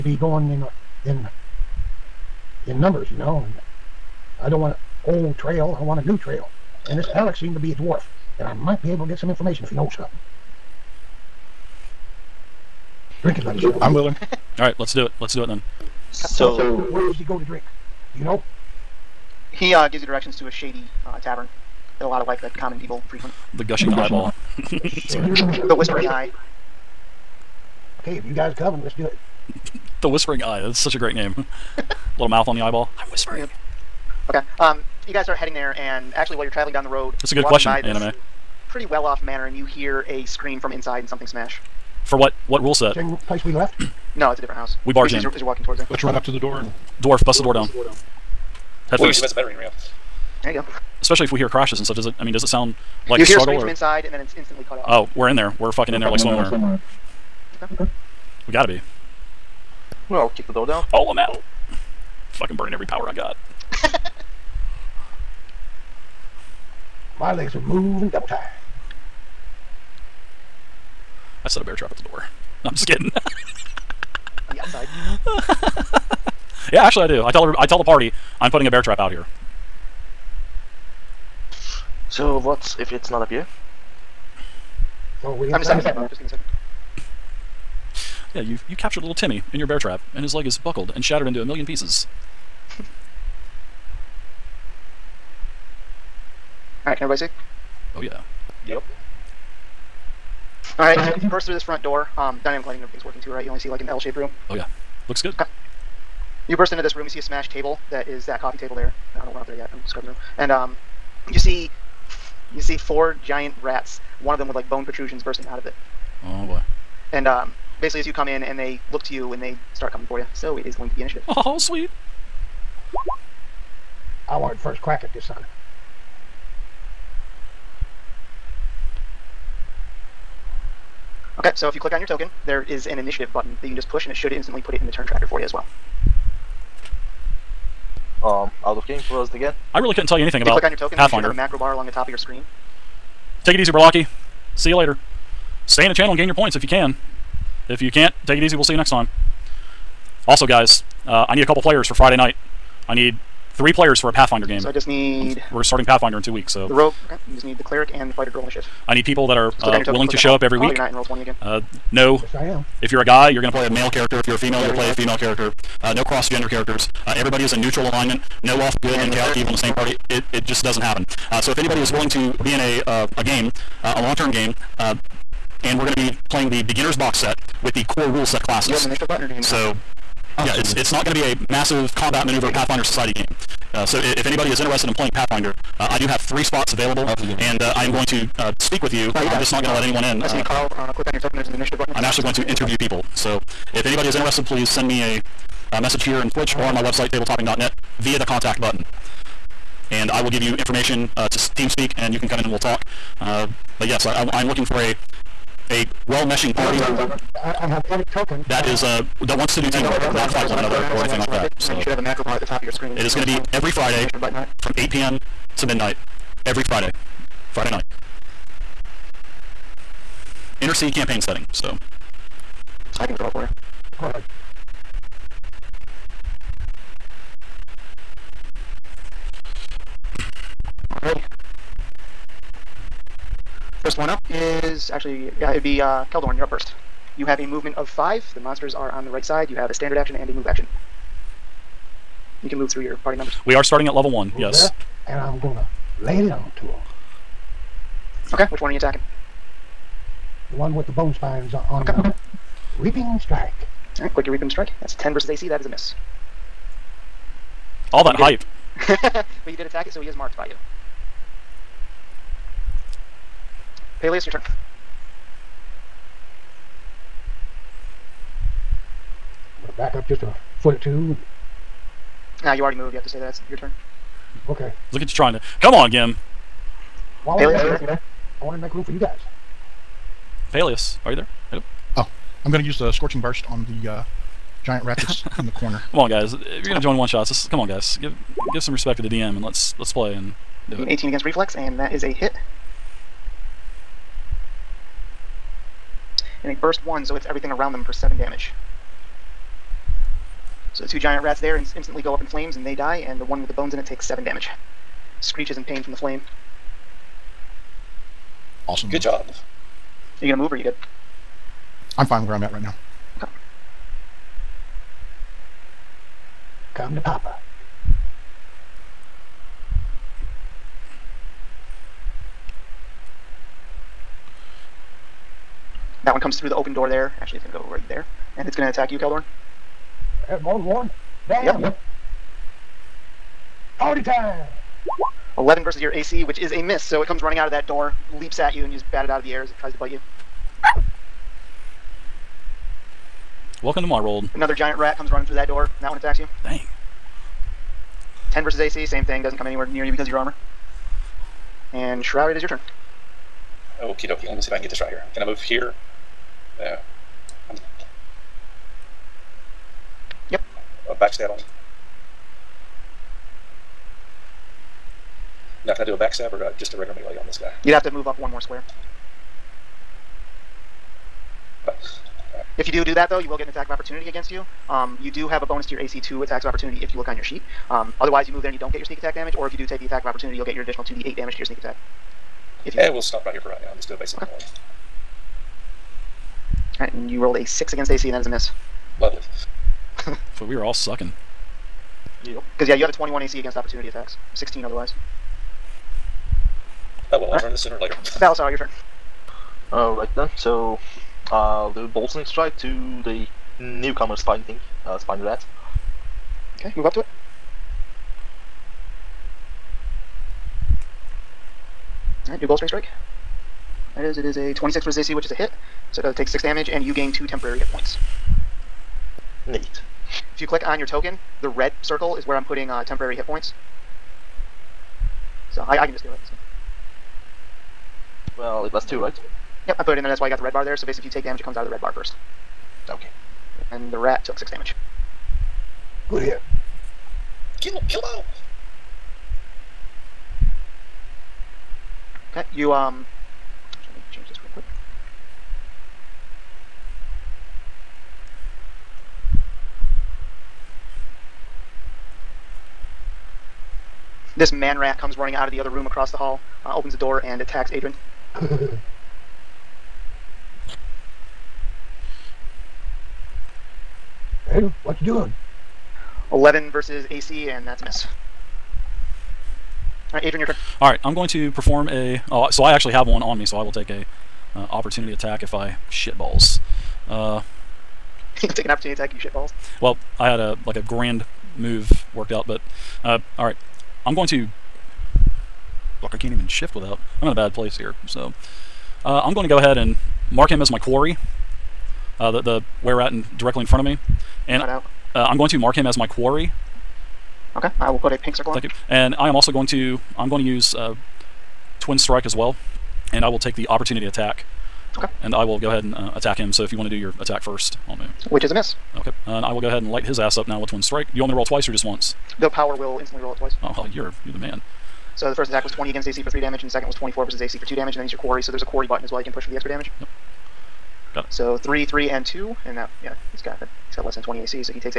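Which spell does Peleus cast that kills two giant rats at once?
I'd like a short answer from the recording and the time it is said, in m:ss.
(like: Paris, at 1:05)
Scorching Burst, at 4:42.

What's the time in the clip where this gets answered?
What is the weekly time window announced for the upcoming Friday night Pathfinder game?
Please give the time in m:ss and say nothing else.
3:34.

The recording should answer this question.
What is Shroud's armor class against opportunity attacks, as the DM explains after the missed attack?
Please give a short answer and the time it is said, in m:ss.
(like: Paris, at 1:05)
21, at 6:32.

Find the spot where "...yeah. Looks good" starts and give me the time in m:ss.
1:44.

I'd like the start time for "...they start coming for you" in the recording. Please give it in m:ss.
1:59.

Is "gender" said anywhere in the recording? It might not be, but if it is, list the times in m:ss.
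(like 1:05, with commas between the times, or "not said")
2:46.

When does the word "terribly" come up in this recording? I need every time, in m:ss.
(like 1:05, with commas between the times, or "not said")
not said.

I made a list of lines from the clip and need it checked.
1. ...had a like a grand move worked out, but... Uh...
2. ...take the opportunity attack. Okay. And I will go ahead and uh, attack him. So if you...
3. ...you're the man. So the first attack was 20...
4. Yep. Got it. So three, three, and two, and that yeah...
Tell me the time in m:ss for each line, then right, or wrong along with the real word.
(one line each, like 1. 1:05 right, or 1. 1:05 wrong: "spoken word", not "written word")
1. 8:00 right
2. 8:23 right
3. 8:34 right
4. 8:39 right.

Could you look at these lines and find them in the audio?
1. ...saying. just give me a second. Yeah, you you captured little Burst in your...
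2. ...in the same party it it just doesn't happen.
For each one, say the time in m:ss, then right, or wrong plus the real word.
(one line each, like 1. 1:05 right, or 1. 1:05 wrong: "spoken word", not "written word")
1. 1:25 wrong: "Timmy", not "Burst"
2. 2:49 right.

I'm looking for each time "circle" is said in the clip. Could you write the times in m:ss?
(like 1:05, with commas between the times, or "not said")
7:01, 8:18.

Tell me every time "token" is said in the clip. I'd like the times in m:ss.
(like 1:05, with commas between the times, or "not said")
2:12, 2:20, 3:11, 3:28, 7:00.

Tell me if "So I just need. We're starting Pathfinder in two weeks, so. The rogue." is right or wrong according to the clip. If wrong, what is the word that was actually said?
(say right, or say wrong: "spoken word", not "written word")
right.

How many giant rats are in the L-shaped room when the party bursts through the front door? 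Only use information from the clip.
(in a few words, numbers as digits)
4.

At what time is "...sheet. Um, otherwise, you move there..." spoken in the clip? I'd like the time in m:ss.
6:17.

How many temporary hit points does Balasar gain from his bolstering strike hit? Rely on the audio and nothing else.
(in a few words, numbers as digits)
2.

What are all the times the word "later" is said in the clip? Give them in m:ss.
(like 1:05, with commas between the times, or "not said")
2:24, 6:37.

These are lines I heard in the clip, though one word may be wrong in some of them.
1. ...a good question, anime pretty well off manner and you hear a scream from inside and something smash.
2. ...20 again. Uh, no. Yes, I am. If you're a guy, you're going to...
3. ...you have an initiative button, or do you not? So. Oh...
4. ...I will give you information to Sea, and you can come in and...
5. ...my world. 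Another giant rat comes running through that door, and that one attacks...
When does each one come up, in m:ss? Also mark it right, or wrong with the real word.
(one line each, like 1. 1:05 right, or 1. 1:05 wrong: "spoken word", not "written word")
1. 0:37 right
2. 2:41 right
3. 2:58 right
4. 3:20 wrong: "TeamSpeak", not "Sea"
5. 5:43 right.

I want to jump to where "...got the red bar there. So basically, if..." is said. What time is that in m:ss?
7:10.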